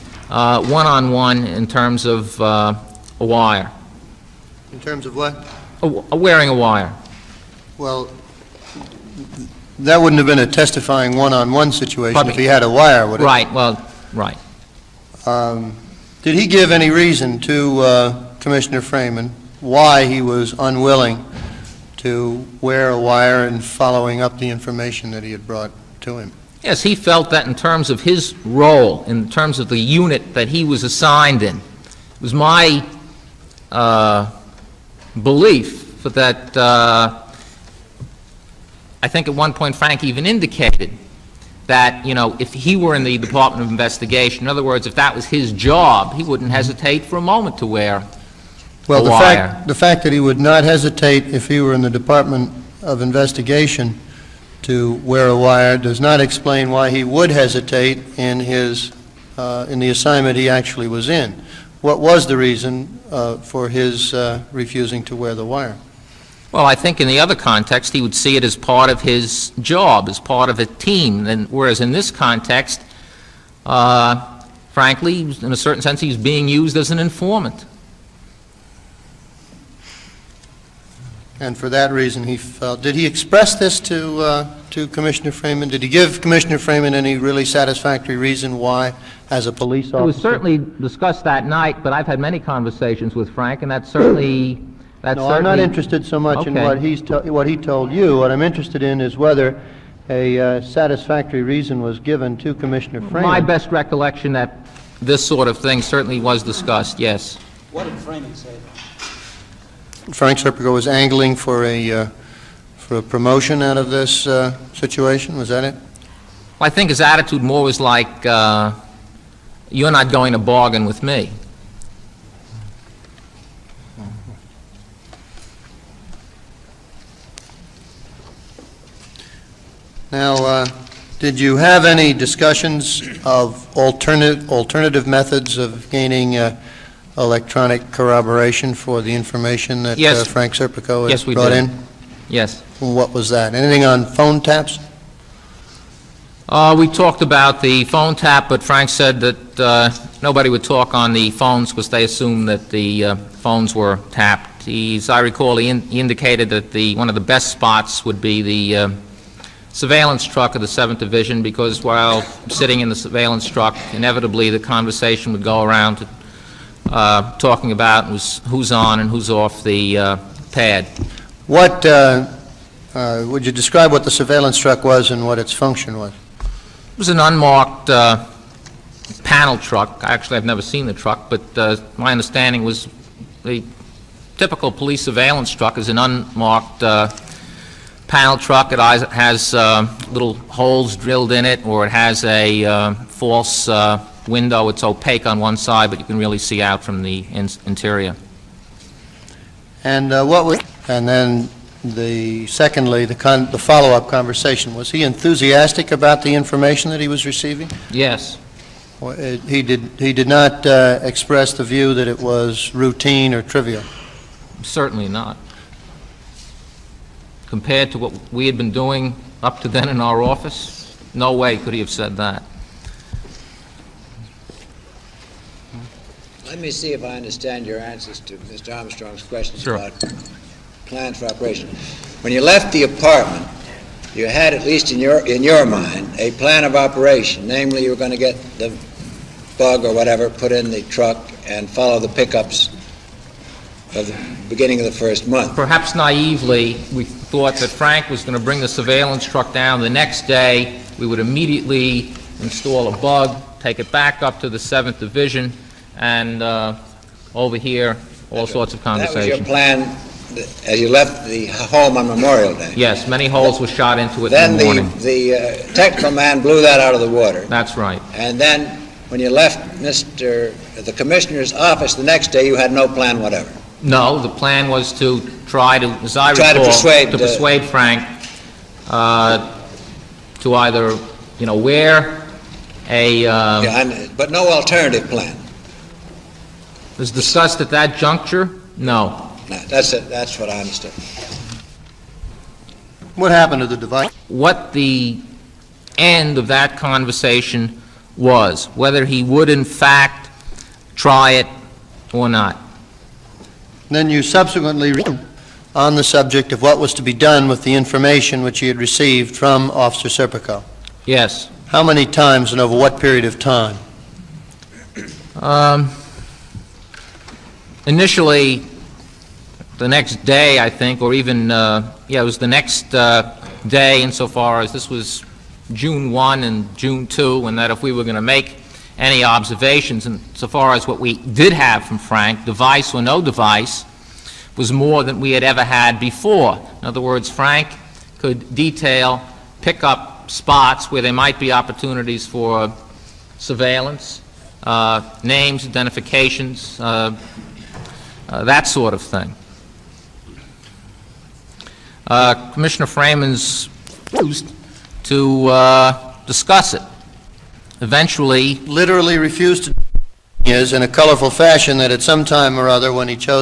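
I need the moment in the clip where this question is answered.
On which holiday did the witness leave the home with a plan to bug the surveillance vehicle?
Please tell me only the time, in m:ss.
4:22.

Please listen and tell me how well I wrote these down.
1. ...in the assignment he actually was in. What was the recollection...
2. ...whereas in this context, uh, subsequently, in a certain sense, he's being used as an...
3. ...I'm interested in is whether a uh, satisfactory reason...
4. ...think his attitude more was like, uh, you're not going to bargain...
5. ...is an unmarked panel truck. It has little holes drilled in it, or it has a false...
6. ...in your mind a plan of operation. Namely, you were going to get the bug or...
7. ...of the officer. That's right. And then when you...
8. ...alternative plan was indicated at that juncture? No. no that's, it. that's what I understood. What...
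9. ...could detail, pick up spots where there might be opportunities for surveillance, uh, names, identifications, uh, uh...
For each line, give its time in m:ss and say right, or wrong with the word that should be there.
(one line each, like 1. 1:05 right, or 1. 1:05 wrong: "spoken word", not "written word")
1. 0:59 wrong: "reason", not "recollection"
2. 1:11 wrong: "frankly", not "subsequently"
3. 1:38 right
4. 1:56 right
5. 3:05 right
6. 3:55 right
7. 4:26 wrong: "water", not "officer"
8. 4:44 wrong: "discussed", not "indicated"
9. 5:38 right.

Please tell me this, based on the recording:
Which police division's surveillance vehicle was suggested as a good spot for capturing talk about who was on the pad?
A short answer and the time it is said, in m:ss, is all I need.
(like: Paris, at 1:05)
7th Division, at 2:40.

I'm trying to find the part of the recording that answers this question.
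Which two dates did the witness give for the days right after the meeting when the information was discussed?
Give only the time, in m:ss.
5:25.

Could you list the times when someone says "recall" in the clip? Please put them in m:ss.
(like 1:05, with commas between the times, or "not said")
2:35, 4:36.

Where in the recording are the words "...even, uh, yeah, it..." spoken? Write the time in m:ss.
5:21.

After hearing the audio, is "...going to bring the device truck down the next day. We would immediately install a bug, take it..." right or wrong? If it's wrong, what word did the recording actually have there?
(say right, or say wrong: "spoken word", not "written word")
wrong: "surveillance", not "device".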